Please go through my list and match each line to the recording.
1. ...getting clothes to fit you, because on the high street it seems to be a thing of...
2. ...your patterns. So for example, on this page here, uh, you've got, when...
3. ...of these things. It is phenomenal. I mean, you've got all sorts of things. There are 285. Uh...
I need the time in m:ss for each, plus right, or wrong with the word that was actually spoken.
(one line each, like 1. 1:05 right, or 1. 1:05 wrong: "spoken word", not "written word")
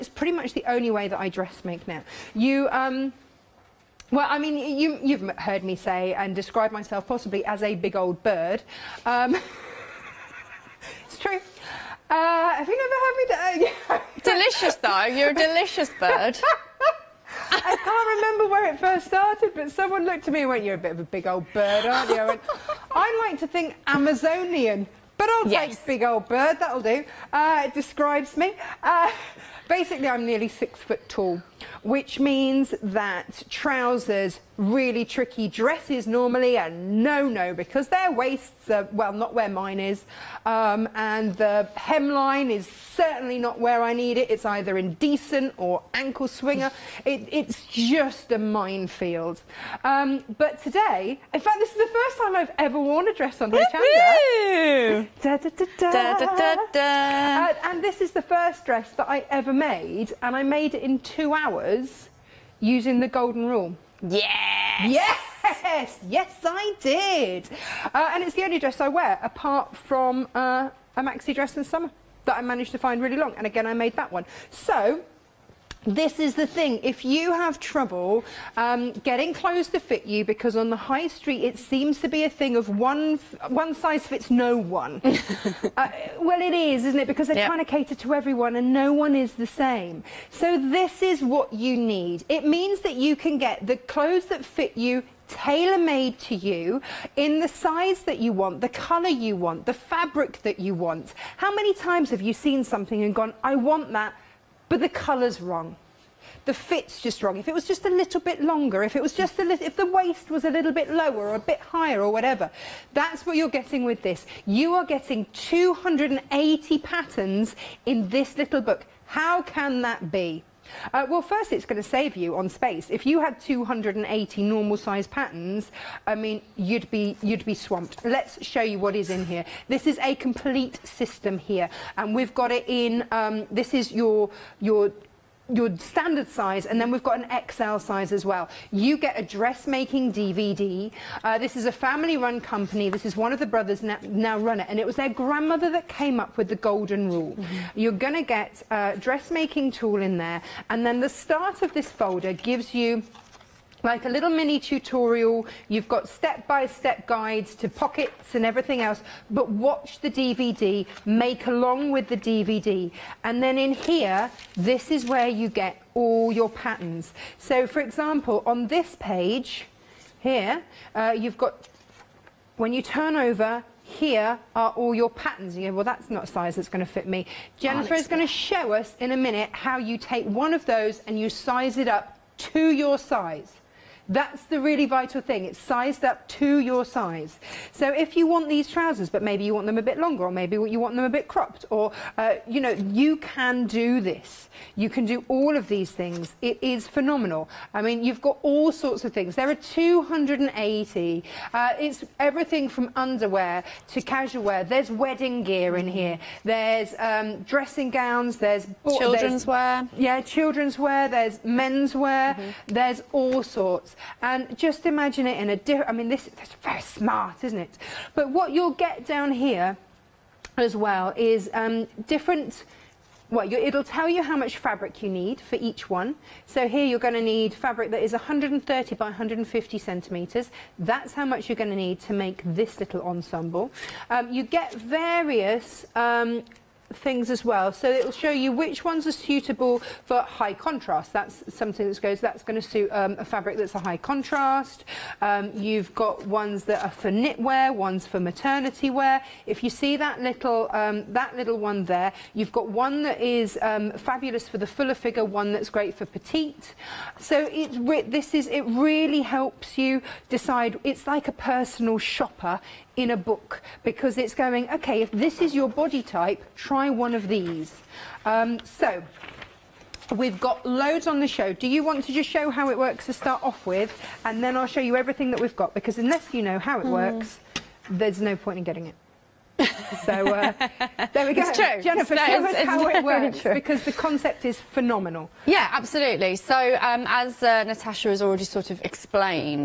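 1. 1:18 right
2. 2:46 right
3. 3:15 wrong: "280", not "285".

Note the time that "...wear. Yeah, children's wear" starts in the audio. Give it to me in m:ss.
3:29.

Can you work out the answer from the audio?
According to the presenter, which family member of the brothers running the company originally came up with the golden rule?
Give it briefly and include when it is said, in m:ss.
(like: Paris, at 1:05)
grandmother, at 2:25.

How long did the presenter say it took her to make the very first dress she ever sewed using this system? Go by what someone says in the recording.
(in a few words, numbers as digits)
2 hours.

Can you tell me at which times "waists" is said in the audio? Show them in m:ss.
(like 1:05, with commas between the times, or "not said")
0:38, 1:49.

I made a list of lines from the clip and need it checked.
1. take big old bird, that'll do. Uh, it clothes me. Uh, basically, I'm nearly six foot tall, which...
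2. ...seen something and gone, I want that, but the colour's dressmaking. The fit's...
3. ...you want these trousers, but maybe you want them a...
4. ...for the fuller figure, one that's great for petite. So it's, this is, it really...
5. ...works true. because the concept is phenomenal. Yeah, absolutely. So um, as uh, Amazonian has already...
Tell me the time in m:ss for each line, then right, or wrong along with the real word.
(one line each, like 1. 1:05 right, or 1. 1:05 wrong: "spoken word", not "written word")
1. 0:25 wrong: "describes", not "clothes"
2. 1:42 wrong: "wrong", not "dressmaking"
3. 3:08 right
4. 4:14 right
5. 4:43 wrong: "Natasha", not "Amazonian".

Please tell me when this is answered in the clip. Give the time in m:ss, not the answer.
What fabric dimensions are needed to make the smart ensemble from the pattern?
3:48.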